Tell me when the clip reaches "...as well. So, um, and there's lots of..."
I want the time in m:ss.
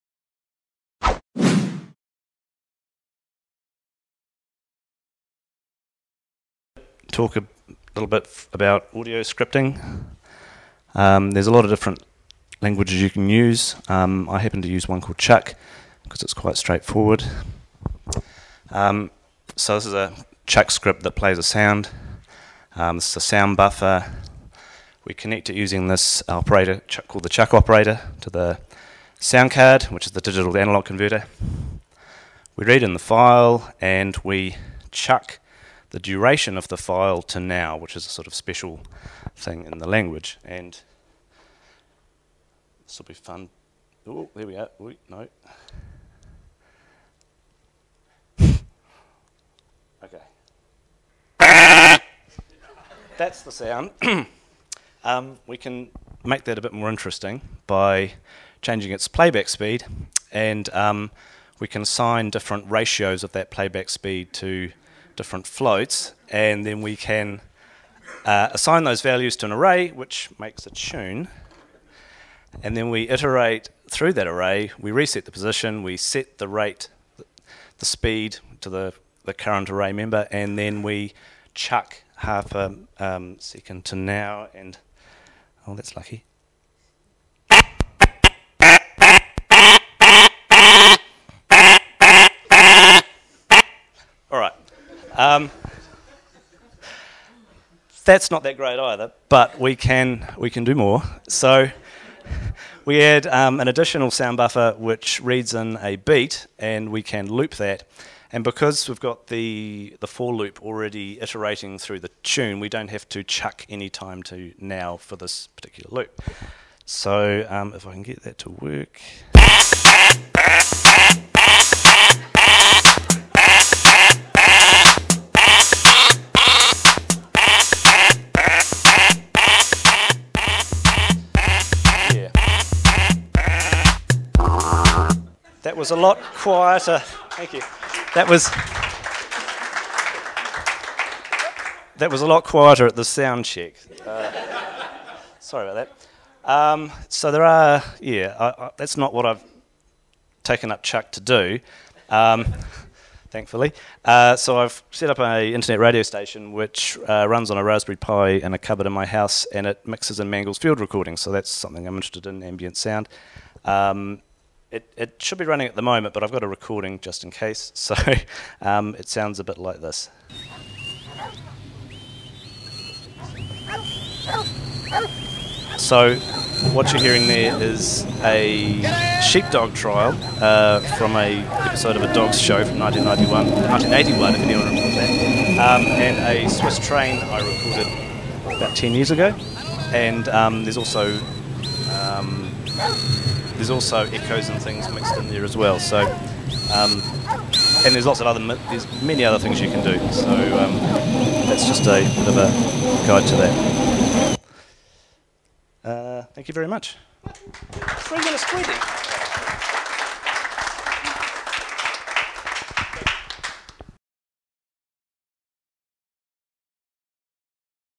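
3:15.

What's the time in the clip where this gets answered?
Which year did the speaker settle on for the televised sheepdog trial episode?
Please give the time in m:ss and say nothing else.
3:03.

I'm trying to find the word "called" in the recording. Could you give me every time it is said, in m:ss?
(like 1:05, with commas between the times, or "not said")
0:15, 0:27.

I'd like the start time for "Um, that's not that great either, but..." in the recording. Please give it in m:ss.
1:35.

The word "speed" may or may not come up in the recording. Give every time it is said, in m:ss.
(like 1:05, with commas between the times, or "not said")
0:59, 1:03, 1:17.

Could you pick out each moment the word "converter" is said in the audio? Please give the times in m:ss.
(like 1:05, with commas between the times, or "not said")
0:30.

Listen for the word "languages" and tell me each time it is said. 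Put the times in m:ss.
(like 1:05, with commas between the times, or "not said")
0:12, 0:39.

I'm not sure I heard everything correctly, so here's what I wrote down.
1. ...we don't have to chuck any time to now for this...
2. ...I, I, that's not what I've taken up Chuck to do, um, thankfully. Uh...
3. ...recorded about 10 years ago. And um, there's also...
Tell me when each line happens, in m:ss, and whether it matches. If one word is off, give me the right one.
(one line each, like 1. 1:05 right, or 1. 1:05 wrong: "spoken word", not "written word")
1. 1:52 right
2. 2:28 right
3. 3:07 right.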